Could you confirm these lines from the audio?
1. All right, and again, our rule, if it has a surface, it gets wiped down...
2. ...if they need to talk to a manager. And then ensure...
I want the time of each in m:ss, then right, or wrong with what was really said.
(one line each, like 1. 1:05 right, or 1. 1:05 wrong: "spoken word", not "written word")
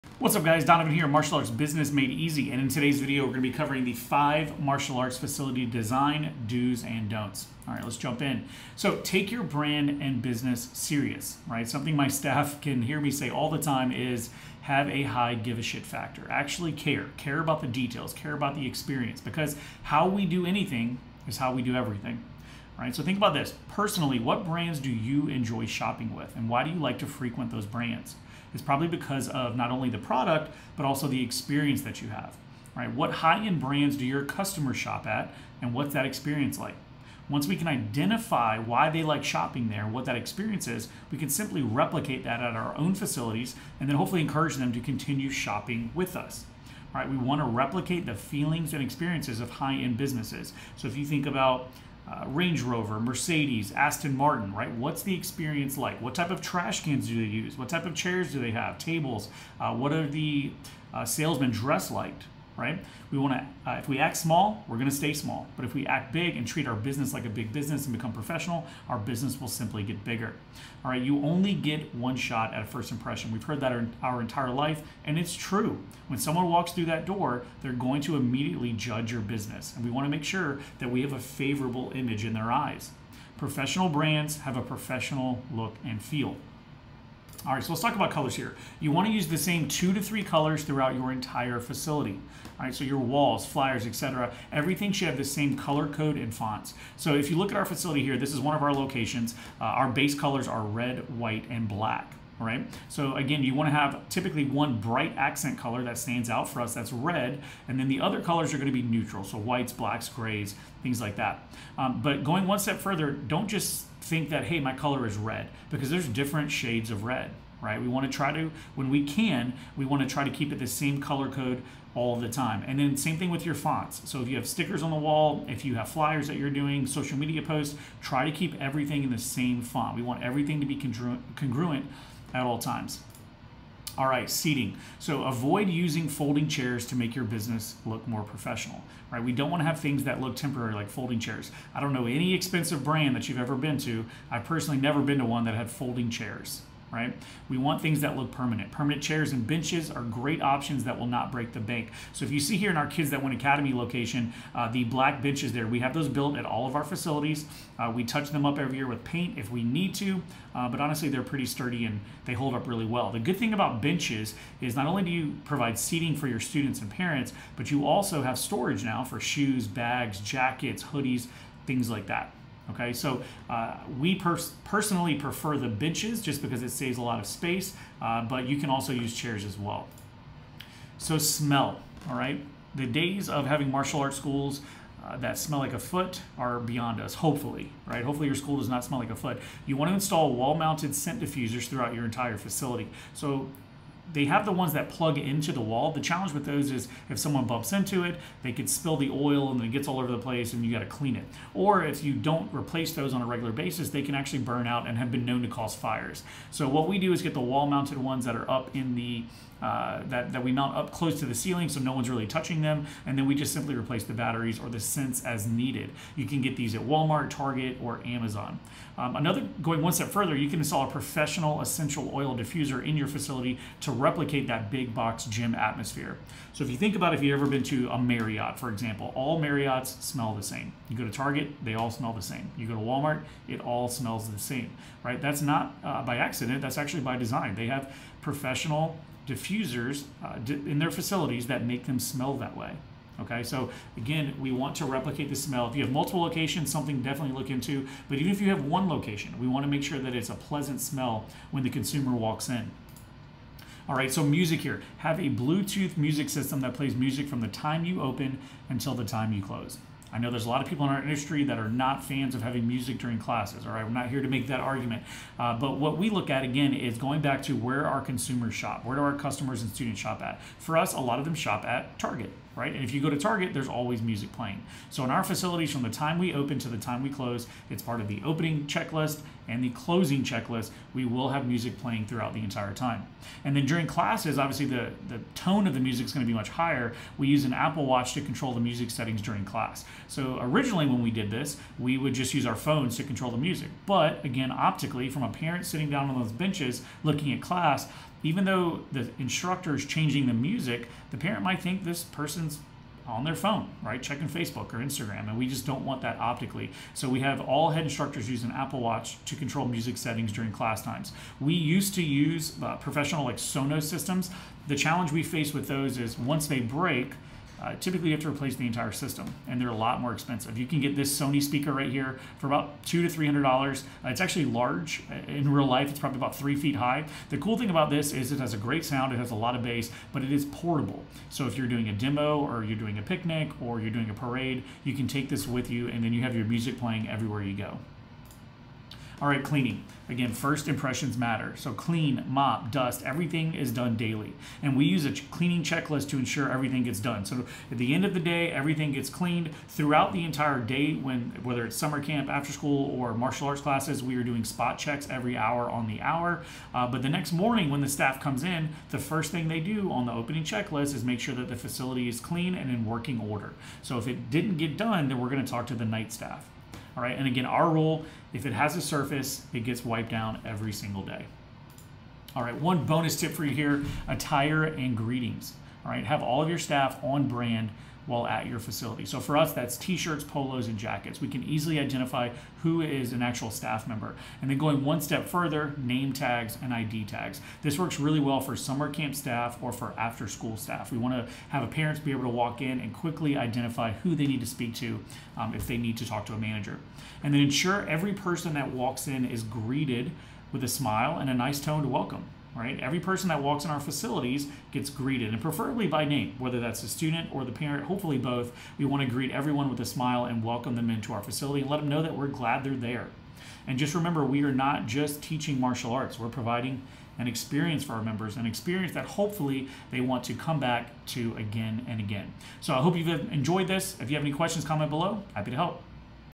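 1. 6:06 right
2. 6:35 right.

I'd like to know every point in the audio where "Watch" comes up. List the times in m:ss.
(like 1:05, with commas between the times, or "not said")
4:47, 5:08.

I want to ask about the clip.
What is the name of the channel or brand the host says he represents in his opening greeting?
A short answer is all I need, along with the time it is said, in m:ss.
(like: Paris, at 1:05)
Martial Arts Business Made Easy, at 0:01.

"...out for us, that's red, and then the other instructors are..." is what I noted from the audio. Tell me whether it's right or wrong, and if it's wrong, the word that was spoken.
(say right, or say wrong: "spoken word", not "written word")
wrong: "colors", not "instructors".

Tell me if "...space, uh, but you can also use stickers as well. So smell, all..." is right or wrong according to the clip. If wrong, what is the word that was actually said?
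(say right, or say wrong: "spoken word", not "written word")
wrong: "chairs", not "stickers".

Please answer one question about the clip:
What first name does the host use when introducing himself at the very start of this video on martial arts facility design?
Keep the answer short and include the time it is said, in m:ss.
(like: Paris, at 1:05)
Donovan, at 0:00.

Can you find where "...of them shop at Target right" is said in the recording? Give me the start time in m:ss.
4:31.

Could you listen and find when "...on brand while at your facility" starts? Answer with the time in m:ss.
6:17.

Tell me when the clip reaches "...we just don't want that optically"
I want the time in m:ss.
5:05.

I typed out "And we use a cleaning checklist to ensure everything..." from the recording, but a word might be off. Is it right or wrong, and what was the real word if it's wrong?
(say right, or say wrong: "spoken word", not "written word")
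right.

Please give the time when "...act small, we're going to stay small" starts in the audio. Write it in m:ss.
1:03.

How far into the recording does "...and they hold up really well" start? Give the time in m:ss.
2:41.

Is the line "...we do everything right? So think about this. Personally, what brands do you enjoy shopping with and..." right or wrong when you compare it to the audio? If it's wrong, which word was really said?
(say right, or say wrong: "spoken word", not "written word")
right.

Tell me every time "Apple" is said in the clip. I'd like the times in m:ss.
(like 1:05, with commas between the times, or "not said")
4:47, 5:08.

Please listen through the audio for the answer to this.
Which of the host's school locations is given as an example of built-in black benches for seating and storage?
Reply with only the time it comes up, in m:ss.
2:32.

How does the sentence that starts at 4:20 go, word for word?
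I know there's a lot of people in our industry that are not fans of having music during classes.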